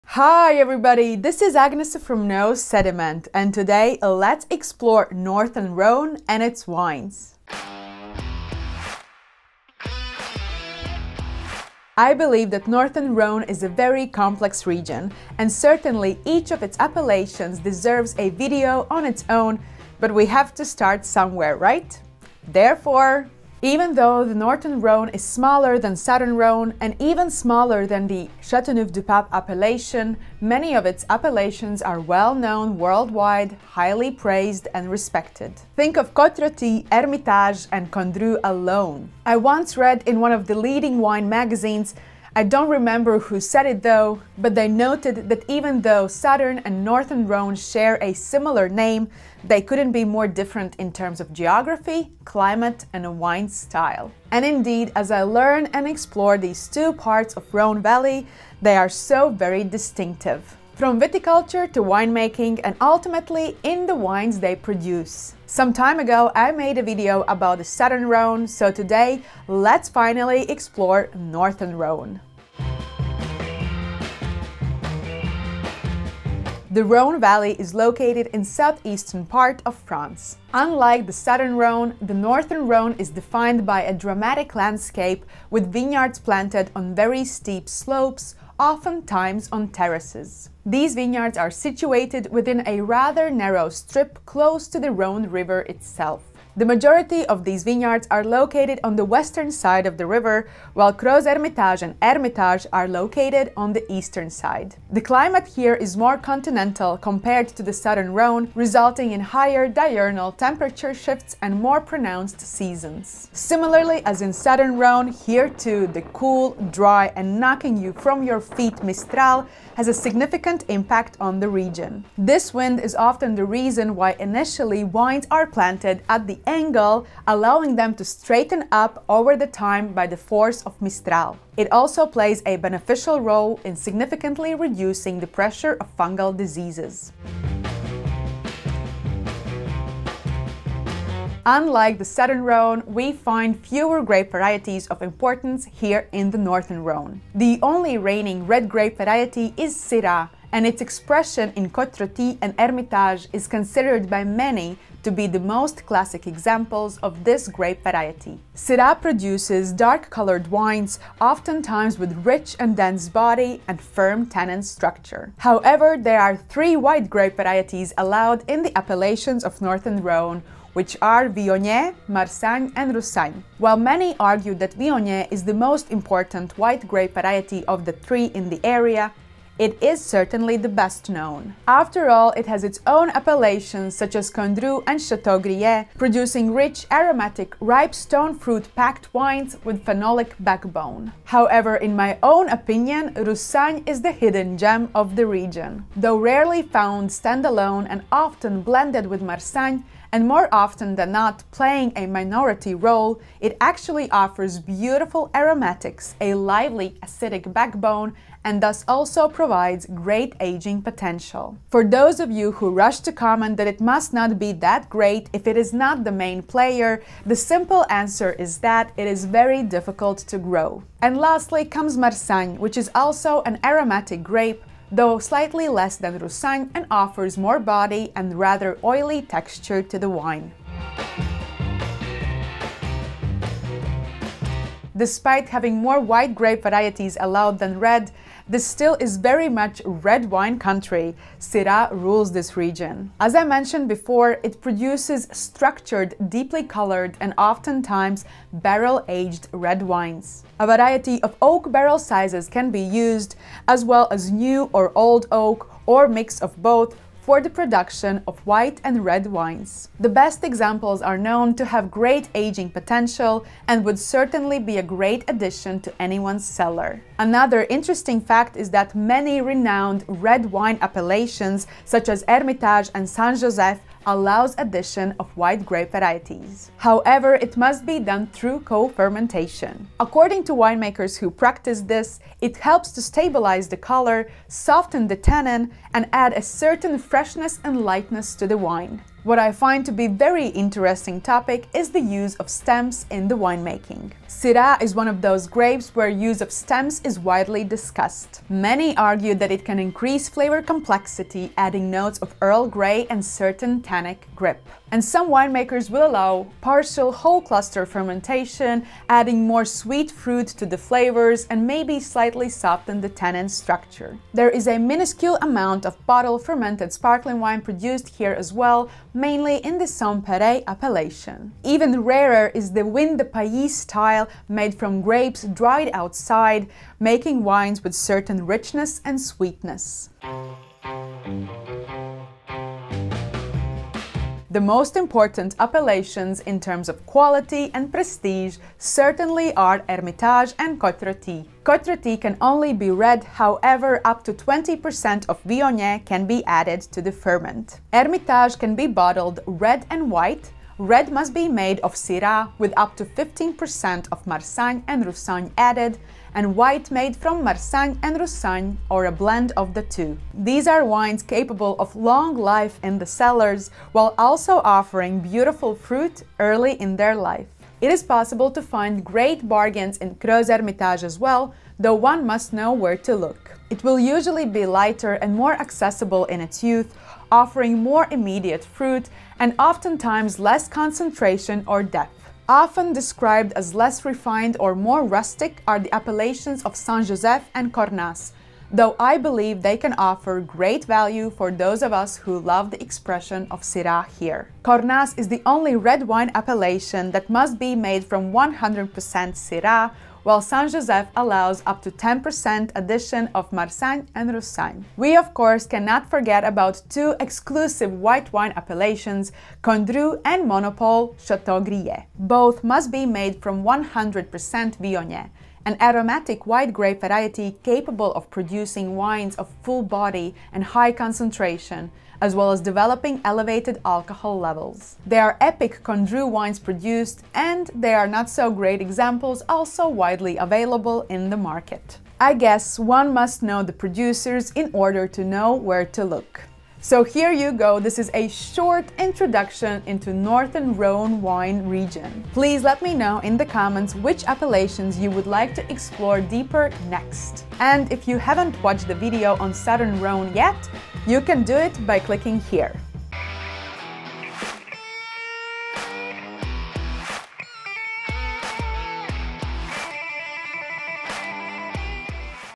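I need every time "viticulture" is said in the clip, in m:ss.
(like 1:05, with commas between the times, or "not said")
1:00.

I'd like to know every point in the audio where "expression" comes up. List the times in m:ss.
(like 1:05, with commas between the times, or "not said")
2:30, 6:32.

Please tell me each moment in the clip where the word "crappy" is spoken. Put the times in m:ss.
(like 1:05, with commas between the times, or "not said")
not said.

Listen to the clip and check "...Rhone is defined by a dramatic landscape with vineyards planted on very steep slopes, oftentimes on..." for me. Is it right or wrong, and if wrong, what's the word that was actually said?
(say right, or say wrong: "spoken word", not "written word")
right.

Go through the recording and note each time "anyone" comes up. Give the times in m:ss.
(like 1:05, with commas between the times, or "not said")
4:26.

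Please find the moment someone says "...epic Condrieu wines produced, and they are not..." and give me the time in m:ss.
7:05.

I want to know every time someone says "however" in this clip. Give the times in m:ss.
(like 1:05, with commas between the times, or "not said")
2:45, 3:11, 4:36, 5:43.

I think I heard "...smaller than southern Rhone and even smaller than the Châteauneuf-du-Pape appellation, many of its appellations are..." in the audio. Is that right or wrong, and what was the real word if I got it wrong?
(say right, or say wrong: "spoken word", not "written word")
right.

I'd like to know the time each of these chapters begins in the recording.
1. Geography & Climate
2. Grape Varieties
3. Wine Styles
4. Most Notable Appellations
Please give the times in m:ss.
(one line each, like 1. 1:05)
1. 1:11
2. 2:17
3. 3:50
4. 5:29.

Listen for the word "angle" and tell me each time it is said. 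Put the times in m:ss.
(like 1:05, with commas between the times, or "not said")
2:06.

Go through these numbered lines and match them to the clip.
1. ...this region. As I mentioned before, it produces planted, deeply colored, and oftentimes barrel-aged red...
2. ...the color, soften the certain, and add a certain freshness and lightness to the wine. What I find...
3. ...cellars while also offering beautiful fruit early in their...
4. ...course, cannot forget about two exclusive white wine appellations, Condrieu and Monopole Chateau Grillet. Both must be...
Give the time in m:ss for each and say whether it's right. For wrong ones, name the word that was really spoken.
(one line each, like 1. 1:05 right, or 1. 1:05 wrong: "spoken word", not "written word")
1. 4:02 wrong: "structured", not "planted"
2. 4:43 wrong: "tannin", not "certain"
3. 6:03 right
4. 6:45 right.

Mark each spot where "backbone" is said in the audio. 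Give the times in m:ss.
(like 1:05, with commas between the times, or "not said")
3:10, 3:27.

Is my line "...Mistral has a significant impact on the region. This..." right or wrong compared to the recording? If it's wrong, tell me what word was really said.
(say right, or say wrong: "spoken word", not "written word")
right.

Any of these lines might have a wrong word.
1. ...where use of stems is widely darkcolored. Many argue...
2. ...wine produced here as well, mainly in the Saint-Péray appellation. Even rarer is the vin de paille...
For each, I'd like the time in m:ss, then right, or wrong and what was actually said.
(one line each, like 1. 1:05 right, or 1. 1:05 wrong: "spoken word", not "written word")
1. 4:55 wrong: "discussed", not "darkcolored"
2. 5:17 right.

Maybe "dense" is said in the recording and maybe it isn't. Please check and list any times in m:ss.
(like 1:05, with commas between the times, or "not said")
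2:42.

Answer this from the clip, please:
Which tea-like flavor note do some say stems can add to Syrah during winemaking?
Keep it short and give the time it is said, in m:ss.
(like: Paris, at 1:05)
Earl Grey, at 5:02.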